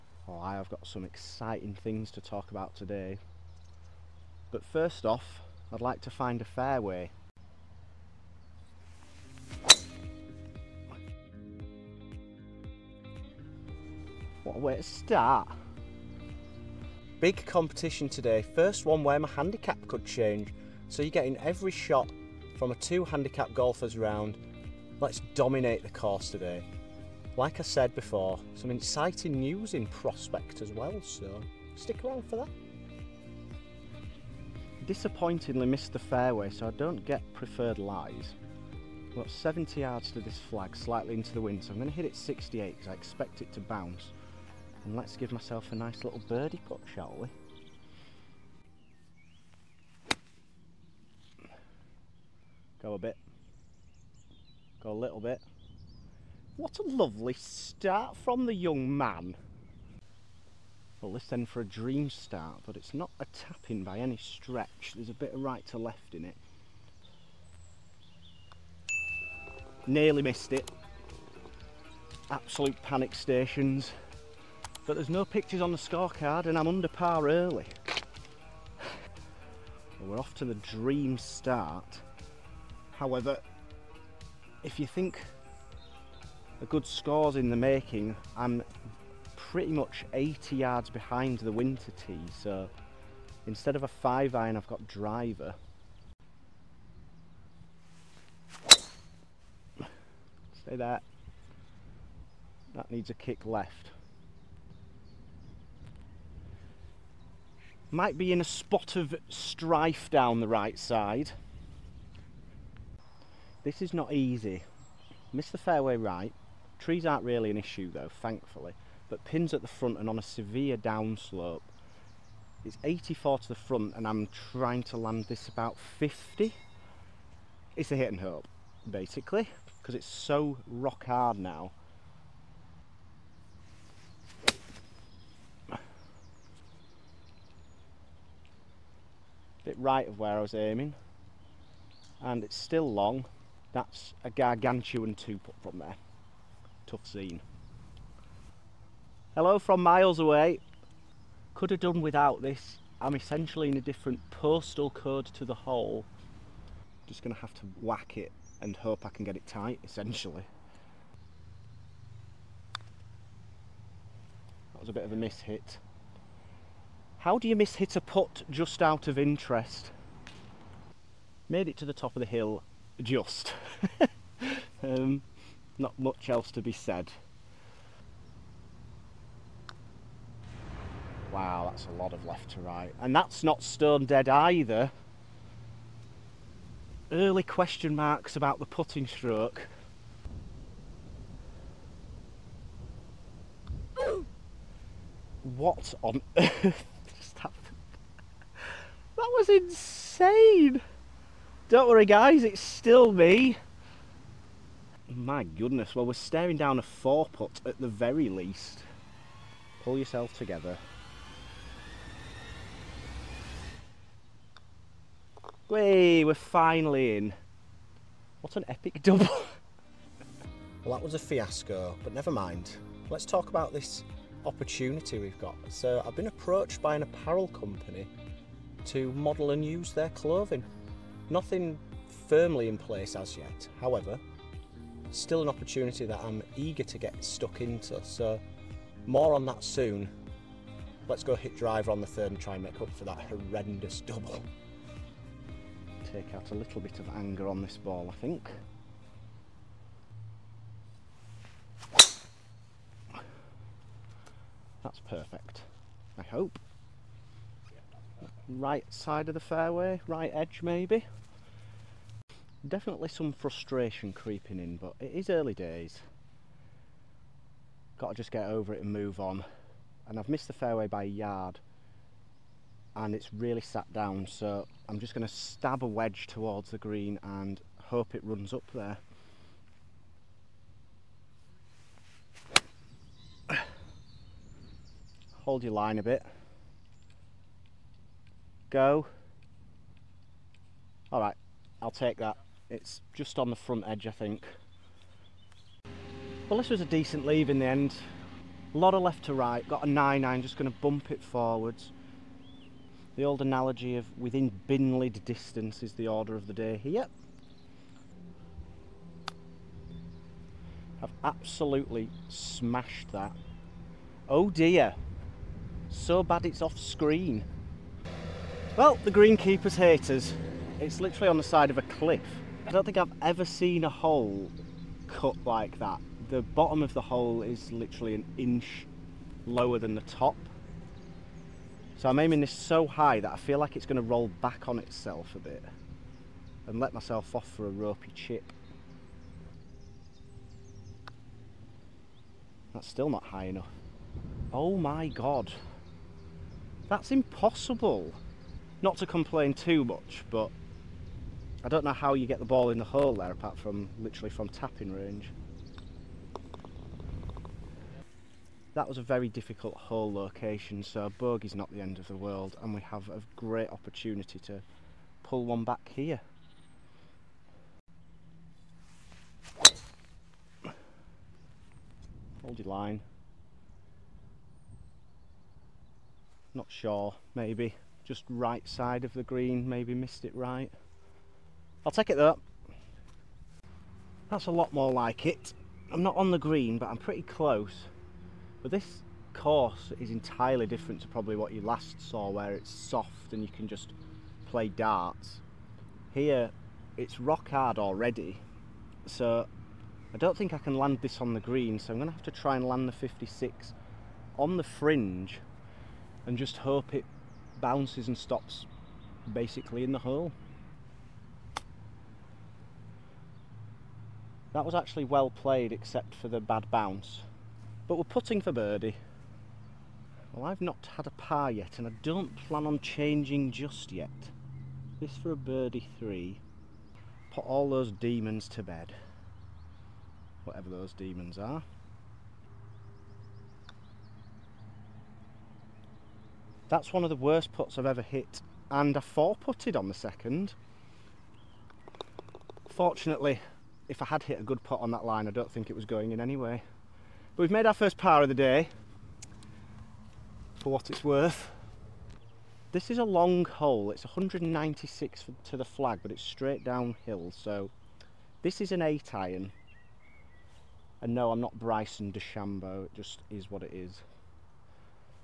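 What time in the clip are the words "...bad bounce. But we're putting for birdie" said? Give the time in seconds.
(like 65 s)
416 s.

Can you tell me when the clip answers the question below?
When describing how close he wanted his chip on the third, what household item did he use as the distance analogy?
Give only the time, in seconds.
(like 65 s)
304 s.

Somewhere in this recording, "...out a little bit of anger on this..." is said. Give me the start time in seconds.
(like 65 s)
246 s.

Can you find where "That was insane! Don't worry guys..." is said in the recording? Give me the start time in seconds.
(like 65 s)
199 s.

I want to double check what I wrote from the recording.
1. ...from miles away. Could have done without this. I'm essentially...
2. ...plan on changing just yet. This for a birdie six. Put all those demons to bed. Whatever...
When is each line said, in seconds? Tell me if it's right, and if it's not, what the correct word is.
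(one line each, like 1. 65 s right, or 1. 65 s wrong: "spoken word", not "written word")
1. 149 s right
2. 422 s wrong: "three", not "six".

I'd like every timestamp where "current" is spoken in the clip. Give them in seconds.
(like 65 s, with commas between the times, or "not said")
not said.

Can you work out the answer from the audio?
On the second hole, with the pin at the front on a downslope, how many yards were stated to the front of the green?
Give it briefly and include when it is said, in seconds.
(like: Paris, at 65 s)
84, at 122 s.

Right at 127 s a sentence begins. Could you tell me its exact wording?
It's a hit and hope, basically, because it's so rock hard now.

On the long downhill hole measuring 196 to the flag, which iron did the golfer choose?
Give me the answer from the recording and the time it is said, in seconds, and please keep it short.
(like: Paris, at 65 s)
8 iron, at 458 s.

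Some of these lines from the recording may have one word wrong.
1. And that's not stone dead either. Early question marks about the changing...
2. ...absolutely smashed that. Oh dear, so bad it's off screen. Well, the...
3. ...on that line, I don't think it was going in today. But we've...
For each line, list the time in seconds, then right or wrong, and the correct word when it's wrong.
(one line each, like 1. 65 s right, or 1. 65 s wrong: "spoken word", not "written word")
1. 183 s wrong: "putting", not "changing"
2. 311 s right
3. 444 s wrong: "anyway", not "today".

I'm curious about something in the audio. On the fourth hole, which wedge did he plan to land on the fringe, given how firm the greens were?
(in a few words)
56.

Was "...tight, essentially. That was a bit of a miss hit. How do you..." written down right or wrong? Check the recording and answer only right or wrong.
right.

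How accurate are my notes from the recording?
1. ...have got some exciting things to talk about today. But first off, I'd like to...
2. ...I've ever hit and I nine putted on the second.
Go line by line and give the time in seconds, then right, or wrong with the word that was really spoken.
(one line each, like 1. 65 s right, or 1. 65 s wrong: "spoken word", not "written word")
1. 0 s right
2. 437 s wrong: "four", not "nine".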